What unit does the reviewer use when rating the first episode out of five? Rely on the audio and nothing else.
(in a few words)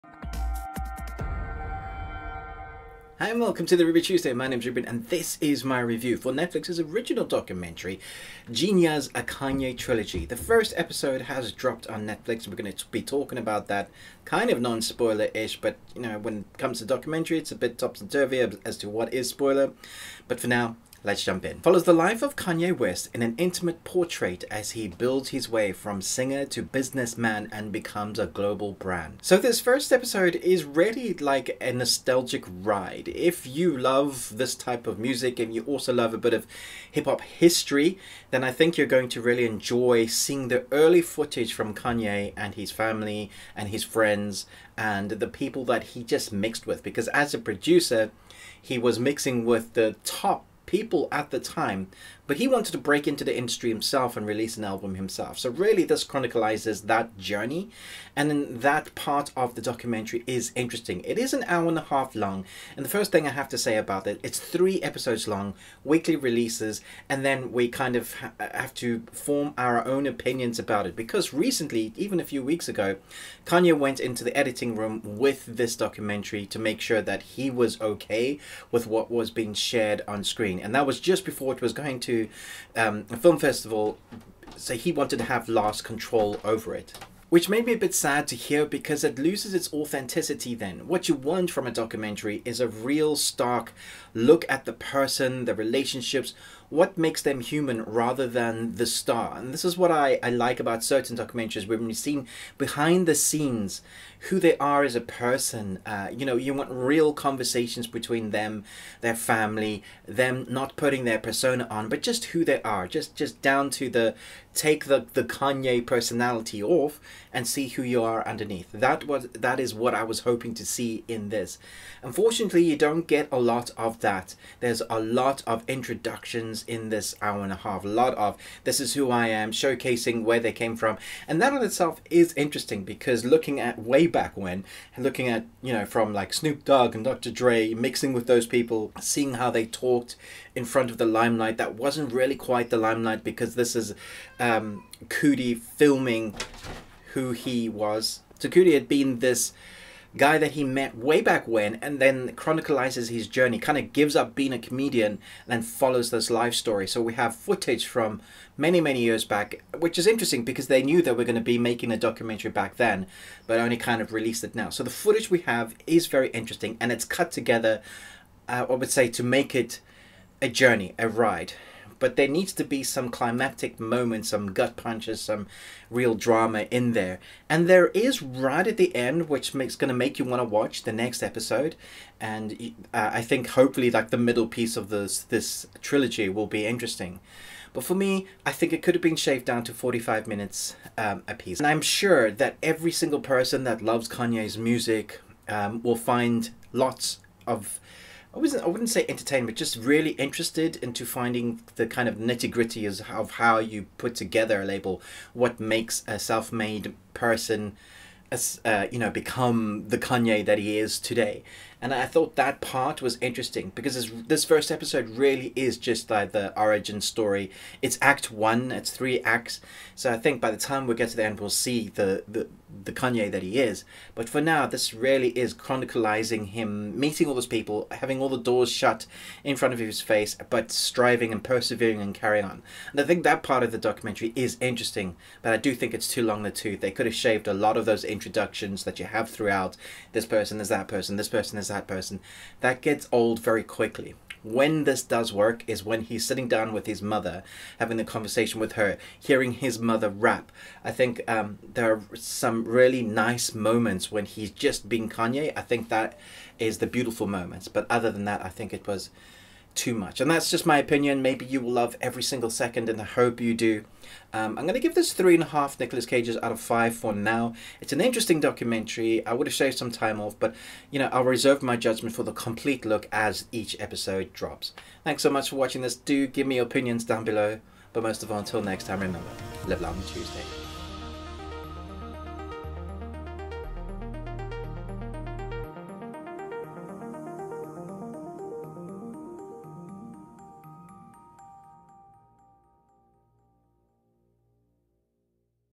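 Nicolas Cages.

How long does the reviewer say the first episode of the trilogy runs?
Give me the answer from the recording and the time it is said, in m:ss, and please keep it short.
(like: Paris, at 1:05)
an hour and a half, at 1:01.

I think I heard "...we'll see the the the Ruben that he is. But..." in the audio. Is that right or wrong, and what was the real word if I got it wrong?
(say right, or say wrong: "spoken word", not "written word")
wrong: "Kanye", not "Ruben".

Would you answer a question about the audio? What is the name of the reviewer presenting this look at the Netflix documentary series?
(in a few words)
Ruben.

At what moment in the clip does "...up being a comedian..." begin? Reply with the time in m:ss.
2:34.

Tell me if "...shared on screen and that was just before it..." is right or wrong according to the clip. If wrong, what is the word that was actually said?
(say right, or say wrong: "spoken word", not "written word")
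right.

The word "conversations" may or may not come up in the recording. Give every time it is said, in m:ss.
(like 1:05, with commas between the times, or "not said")
1:47, 4:08.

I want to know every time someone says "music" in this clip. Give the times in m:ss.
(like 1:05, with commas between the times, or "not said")
0:34, 3:14.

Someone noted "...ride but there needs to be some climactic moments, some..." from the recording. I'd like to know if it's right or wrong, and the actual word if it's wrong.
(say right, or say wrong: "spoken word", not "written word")
right.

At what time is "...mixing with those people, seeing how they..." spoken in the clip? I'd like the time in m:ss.
2:17.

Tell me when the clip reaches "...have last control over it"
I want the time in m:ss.
1:25.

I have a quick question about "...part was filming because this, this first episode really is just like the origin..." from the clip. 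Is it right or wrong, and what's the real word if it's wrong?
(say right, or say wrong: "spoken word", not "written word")
wrong: "interesting", not "filming".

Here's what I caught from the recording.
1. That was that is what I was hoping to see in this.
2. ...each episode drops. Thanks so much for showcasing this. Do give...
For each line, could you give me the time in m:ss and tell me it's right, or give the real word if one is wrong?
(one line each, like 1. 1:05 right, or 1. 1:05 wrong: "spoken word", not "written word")
1. 1:58 right
2. 4:33 wrong: "watching", not "showcasing".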